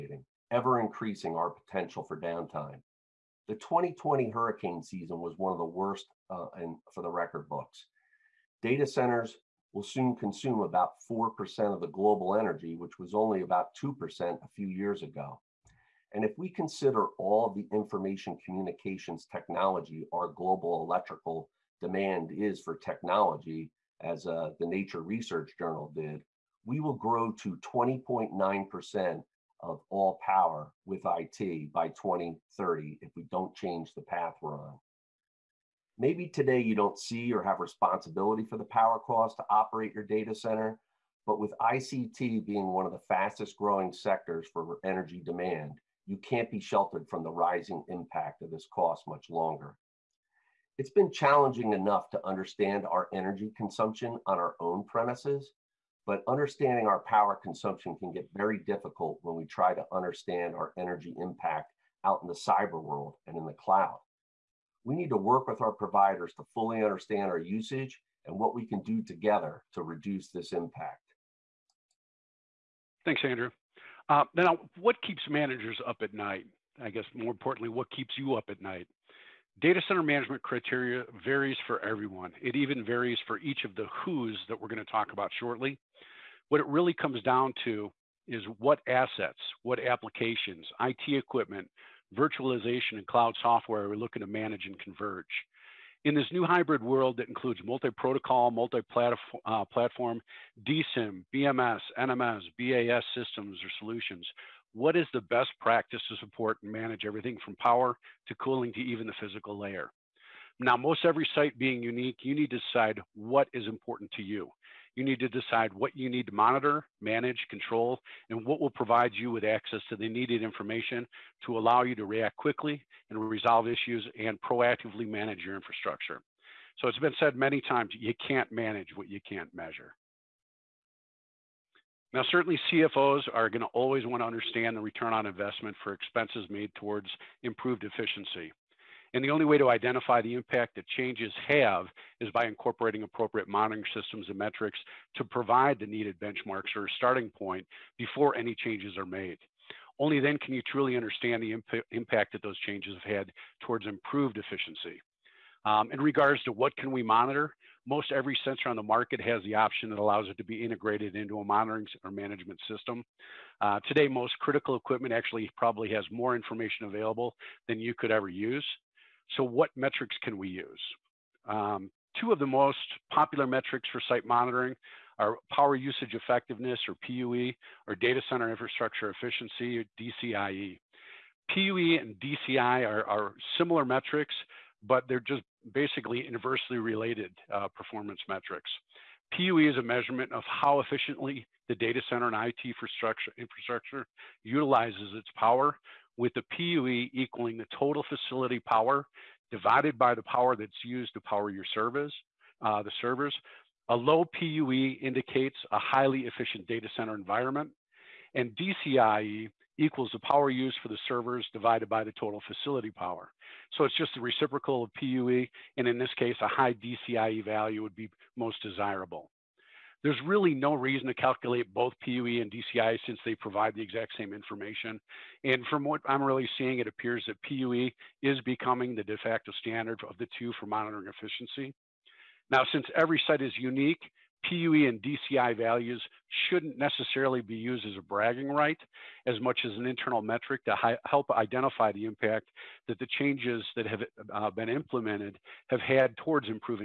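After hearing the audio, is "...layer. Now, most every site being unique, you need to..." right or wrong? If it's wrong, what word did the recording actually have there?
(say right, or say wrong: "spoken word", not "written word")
right.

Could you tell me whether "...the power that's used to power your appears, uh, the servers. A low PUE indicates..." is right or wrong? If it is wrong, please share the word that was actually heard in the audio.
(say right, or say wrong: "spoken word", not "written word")
wrong: "servers", not "appears".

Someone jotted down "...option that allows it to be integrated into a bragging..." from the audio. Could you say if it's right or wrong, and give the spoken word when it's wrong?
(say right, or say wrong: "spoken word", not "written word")
wrong: "monitoring", not "bragging".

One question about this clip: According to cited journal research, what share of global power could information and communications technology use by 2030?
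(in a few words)
20.9%.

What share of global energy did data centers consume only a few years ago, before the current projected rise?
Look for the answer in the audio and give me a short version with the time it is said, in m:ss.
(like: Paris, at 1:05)
2%, at 0:13.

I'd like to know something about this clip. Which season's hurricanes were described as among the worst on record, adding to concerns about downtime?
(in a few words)
2020.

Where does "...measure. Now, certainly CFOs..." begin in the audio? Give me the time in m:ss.
2:09.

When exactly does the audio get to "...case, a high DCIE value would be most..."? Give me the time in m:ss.
3:36.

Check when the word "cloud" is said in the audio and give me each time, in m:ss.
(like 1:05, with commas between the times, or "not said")
1:03, 1:33.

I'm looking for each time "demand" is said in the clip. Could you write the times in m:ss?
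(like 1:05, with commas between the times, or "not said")
0:21, 0:45.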